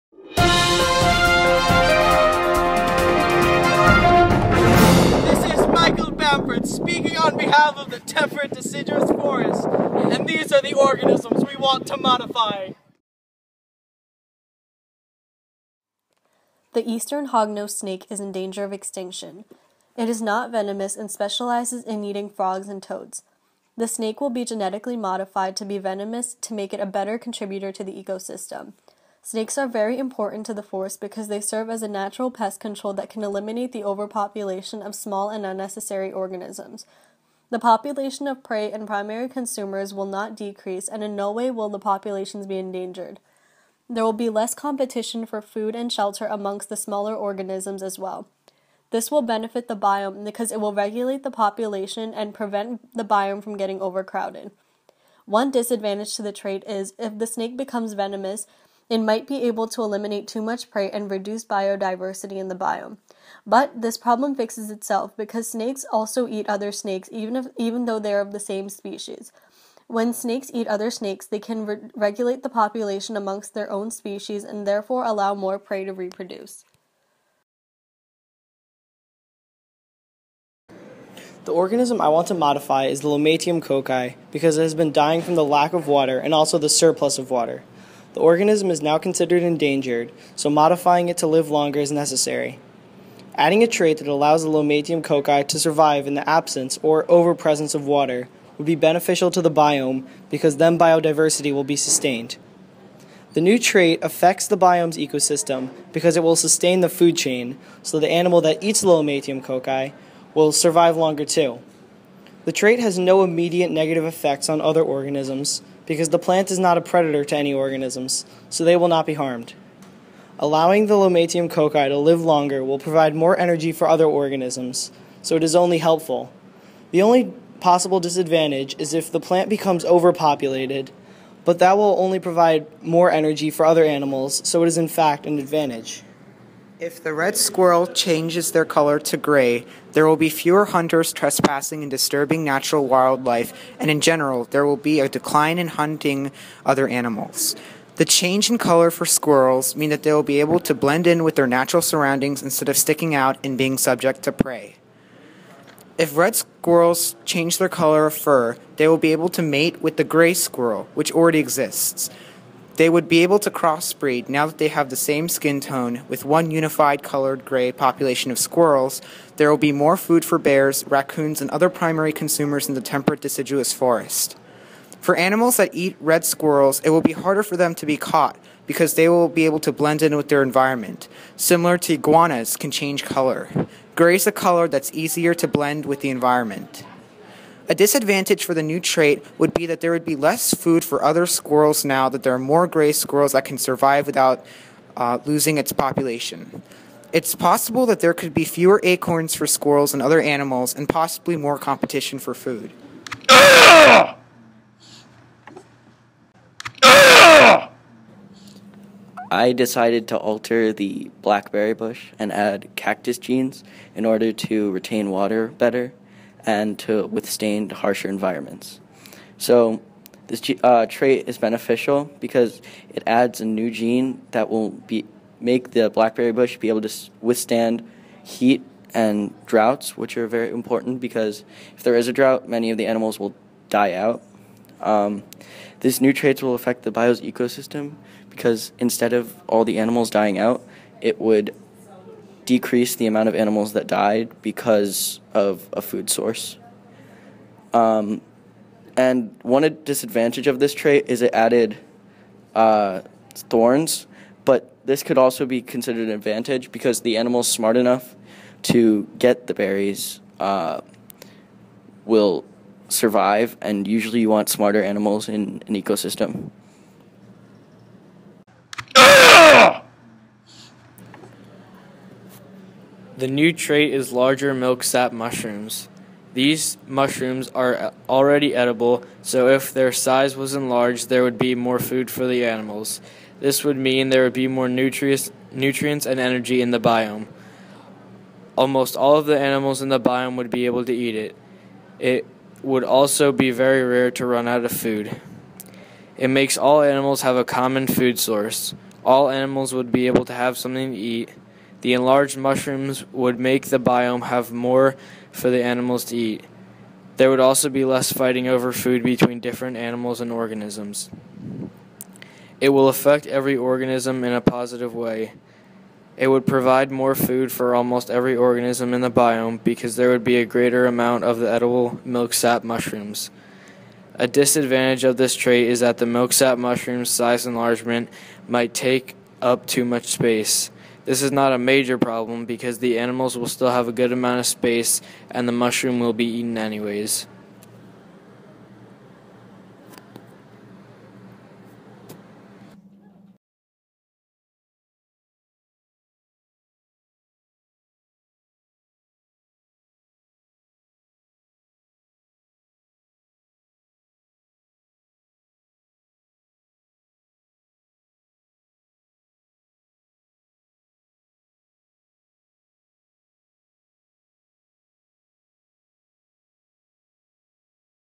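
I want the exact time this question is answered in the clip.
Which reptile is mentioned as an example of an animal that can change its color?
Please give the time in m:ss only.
3:01.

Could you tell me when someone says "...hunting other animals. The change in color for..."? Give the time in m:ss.
2:25.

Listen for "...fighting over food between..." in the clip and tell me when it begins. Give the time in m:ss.
5:08.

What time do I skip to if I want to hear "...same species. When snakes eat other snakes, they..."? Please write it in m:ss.
1:08.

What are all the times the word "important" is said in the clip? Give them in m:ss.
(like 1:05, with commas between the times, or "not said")
0:29, 3:50.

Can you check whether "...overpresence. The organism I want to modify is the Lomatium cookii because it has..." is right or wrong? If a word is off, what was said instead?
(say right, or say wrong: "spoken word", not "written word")
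wrong: "reproduce", not "overpresence".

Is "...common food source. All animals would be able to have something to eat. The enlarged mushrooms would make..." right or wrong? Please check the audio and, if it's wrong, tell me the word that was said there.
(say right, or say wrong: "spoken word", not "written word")
right.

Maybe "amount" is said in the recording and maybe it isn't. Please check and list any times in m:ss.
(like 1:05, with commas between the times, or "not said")
4:03, 5:20, 5:34.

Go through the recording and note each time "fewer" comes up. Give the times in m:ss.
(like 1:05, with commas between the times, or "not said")
2:20, 3:18.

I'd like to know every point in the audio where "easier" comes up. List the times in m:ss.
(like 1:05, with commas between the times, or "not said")
3:04.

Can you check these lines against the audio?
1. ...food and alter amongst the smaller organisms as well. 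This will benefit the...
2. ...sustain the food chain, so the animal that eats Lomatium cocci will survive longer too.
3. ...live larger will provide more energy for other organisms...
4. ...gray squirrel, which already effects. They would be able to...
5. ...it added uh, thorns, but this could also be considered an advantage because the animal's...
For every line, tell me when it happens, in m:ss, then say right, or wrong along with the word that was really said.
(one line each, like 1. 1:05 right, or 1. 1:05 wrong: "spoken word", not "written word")
1. 0:45 wrong: "shelter", not "alter"
2. 1:46 right
3. 2:01 wrong: "longer", not "larger"
4. 2:40 wrong: "exists", not "effects"
5. 4:11 right.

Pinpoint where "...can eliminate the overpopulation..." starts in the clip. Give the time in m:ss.
0:33.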